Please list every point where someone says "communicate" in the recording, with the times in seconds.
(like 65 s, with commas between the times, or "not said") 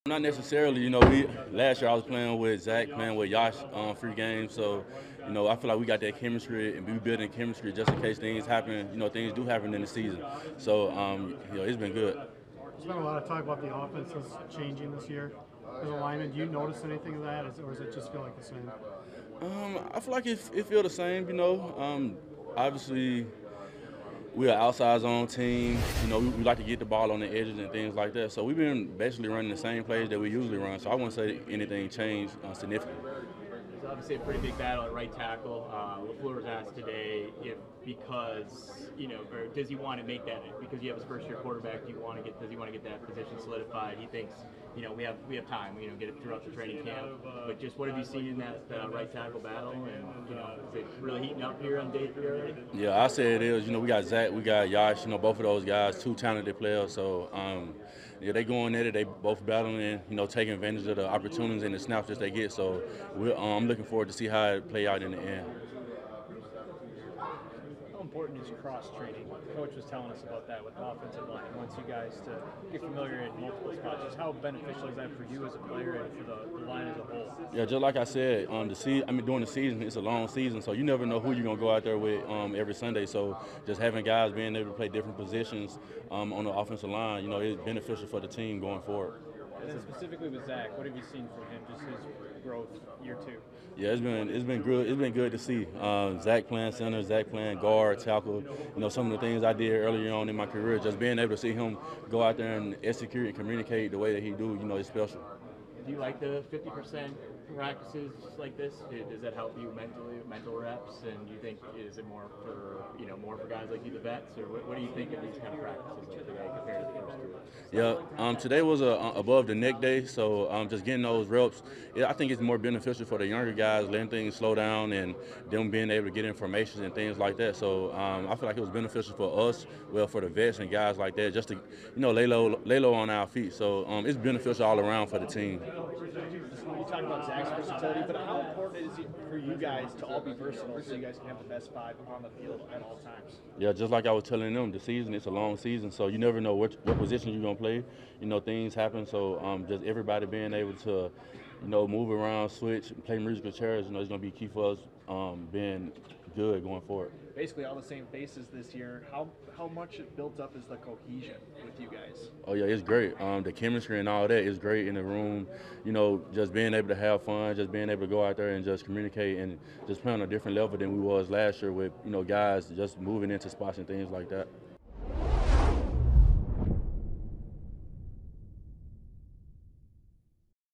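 103 s, 168 s.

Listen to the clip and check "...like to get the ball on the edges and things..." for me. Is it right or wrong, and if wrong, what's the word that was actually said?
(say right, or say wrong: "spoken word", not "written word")
right.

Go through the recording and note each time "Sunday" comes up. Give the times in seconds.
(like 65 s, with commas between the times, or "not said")
82 s.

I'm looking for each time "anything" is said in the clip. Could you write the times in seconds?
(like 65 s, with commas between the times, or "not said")
16 s, 31 s.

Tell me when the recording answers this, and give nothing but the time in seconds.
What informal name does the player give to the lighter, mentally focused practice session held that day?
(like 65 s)
119 s.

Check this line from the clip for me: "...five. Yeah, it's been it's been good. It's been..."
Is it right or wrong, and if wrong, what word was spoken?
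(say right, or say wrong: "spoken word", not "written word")
wrong: "two", not "five".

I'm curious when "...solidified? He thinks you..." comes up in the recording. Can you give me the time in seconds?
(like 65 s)
43 s.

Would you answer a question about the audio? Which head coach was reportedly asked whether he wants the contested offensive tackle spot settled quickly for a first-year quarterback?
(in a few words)
LaFleur.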